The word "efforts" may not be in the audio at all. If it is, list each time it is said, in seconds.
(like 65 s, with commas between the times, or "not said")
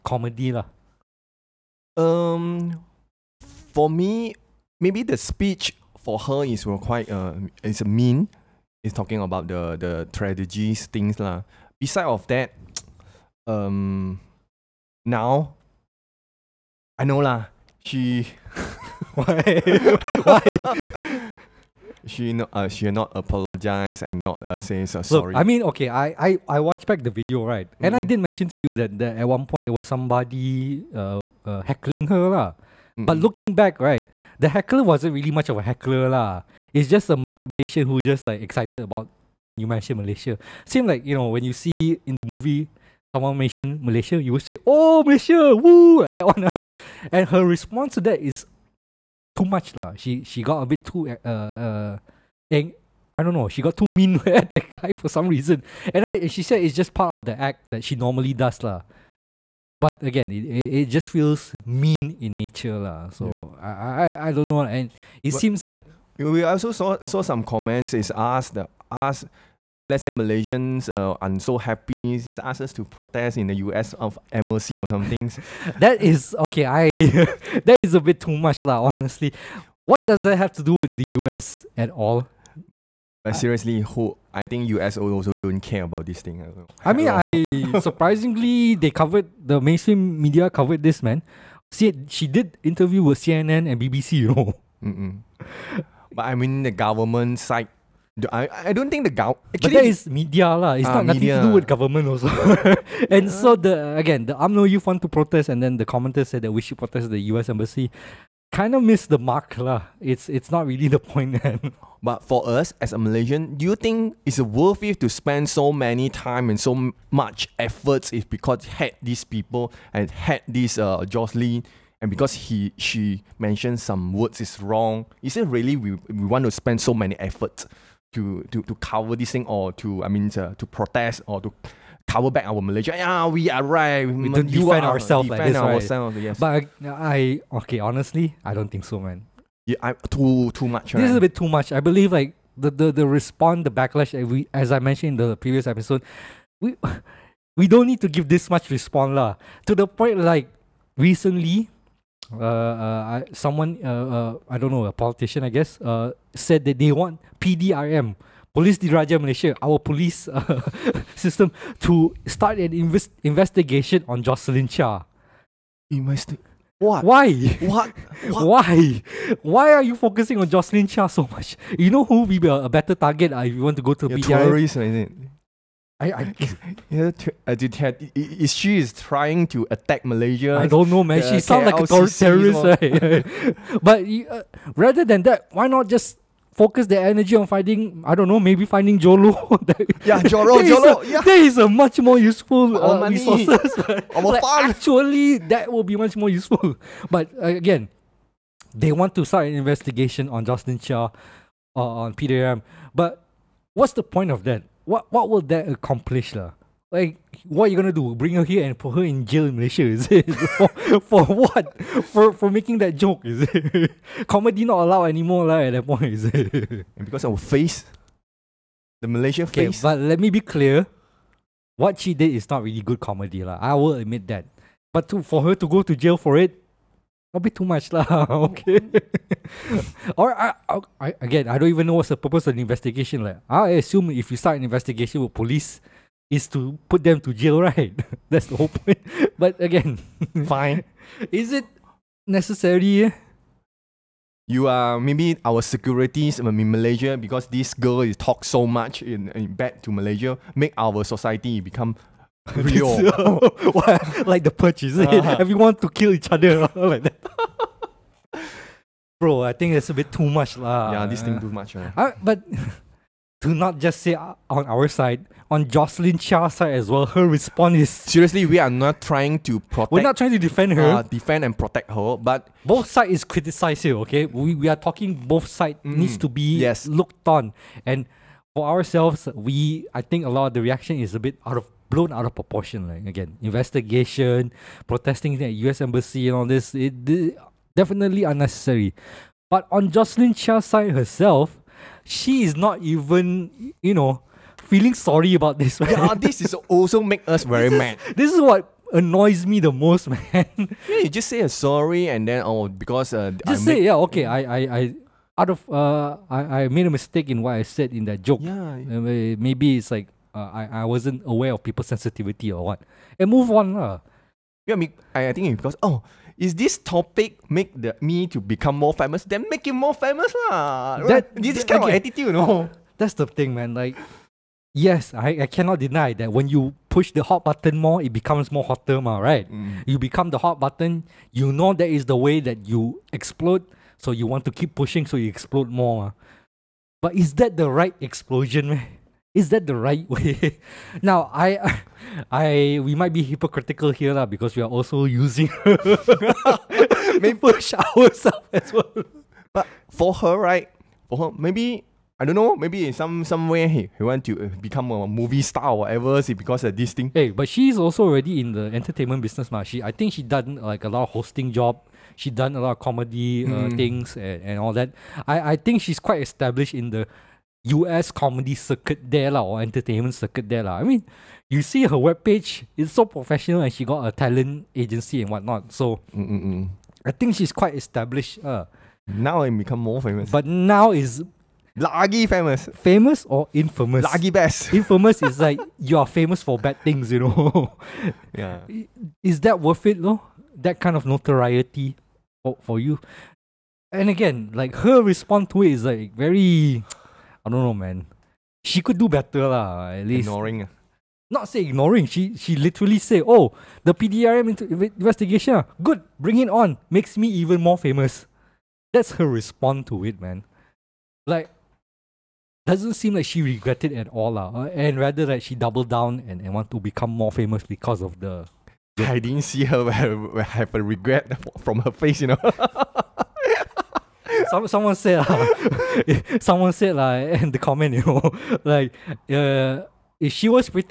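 117 s, 127 s.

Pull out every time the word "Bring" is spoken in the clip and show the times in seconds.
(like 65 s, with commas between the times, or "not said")
208 s, 406 s.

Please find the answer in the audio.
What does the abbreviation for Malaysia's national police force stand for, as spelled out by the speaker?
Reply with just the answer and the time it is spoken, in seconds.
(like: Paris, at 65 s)
Police Diraja Malaysia, at 158 s.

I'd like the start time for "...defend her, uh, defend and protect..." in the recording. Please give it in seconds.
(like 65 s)
270 s.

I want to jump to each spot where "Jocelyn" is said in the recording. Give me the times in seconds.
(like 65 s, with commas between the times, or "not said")
121 s, 164 s, 170 s, 200 s, 265 s, 289 s.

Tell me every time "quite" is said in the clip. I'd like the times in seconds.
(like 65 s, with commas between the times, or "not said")
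6 s, 366 s, 377 s.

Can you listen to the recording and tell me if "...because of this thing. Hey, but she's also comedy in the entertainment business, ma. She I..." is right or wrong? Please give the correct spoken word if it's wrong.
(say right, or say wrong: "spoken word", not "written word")
wrong: "already", not "comedy".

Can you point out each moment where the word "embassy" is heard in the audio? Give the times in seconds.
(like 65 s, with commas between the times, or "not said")
107 s, 285 s.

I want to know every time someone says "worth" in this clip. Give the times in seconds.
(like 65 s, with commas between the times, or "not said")
114 s, 389 s.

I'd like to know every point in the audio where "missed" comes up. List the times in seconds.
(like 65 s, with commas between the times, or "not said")
108 s.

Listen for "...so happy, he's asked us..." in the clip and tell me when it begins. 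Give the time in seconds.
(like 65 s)
71 s.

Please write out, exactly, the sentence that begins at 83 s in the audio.
But seriously, who I think US also don't care about this thing.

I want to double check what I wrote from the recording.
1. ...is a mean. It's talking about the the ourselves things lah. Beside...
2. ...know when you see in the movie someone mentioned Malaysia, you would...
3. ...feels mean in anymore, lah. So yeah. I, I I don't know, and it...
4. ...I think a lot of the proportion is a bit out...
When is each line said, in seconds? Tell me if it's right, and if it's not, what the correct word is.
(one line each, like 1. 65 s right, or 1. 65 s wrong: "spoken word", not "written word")
1. 7 s wrong: "tragedies", not "ourselves"
2. 41 s right
3. 61 s wrong: "nature", not "anymore"
4. 279 s wrong: "reaction", not "proportion".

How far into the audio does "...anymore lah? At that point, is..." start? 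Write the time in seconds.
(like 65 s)
215 s.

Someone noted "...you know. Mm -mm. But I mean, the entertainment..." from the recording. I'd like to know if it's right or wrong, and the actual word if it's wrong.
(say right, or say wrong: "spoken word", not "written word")
wrong: "government", not "entertainment".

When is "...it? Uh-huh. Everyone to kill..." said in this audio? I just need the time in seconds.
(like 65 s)
254 s.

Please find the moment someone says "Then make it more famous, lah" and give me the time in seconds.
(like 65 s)
319 s.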